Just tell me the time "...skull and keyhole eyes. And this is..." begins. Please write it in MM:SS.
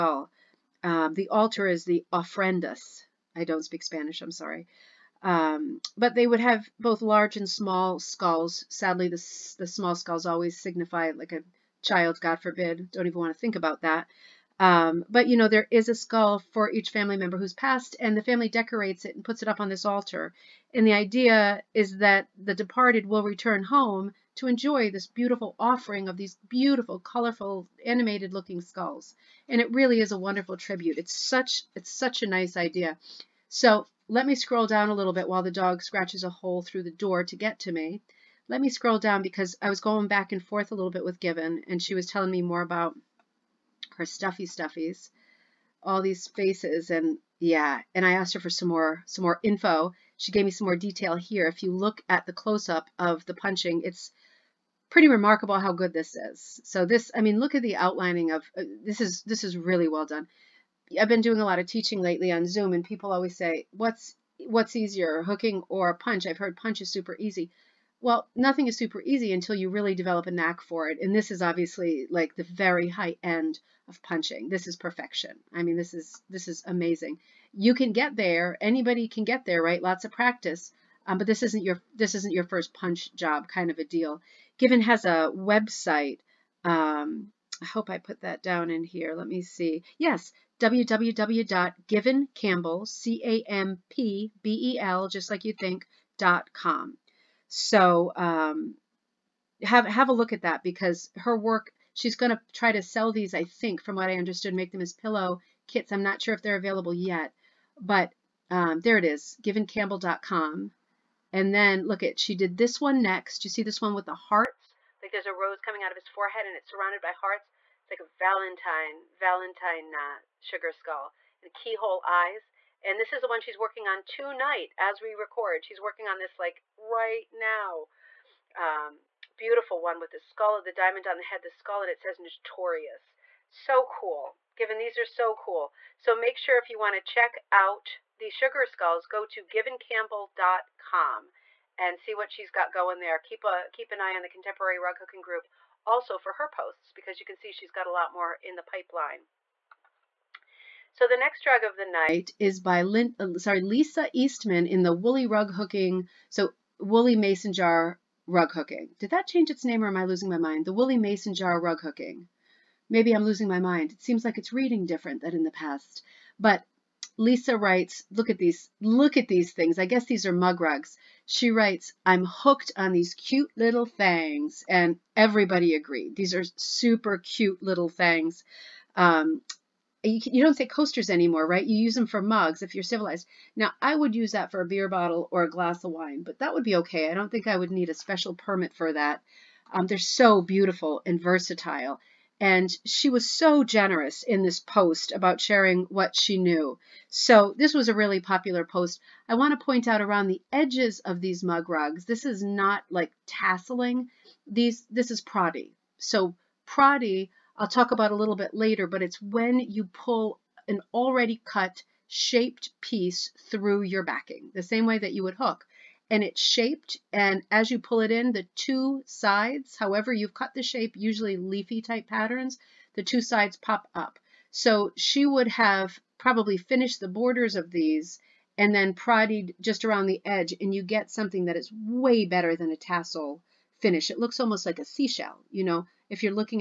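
02:00.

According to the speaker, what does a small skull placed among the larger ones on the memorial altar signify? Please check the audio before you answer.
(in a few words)
A child.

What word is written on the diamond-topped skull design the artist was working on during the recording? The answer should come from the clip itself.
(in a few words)
Notorious.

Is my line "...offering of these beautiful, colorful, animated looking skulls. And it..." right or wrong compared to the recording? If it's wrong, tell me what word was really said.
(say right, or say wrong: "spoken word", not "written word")
right.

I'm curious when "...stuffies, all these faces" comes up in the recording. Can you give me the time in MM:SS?
00:44.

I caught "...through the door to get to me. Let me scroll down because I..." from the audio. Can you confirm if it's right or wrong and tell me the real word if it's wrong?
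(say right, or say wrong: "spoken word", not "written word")
right.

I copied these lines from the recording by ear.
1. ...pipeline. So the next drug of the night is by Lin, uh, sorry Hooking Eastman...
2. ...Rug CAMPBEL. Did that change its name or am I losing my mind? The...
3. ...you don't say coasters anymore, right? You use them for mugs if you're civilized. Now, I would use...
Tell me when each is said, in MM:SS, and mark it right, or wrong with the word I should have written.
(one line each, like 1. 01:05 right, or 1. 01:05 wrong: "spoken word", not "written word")
1. 02:28 wrong: "Lisa", not "Hooking"
2. 02:38 wrong: "Hooking", not "CAMPBEL"
3. 03:00 right.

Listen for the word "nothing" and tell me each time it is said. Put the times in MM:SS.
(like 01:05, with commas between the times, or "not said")
01:08.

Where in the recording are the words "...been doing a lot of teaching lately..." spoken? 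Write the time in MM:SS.
01:01.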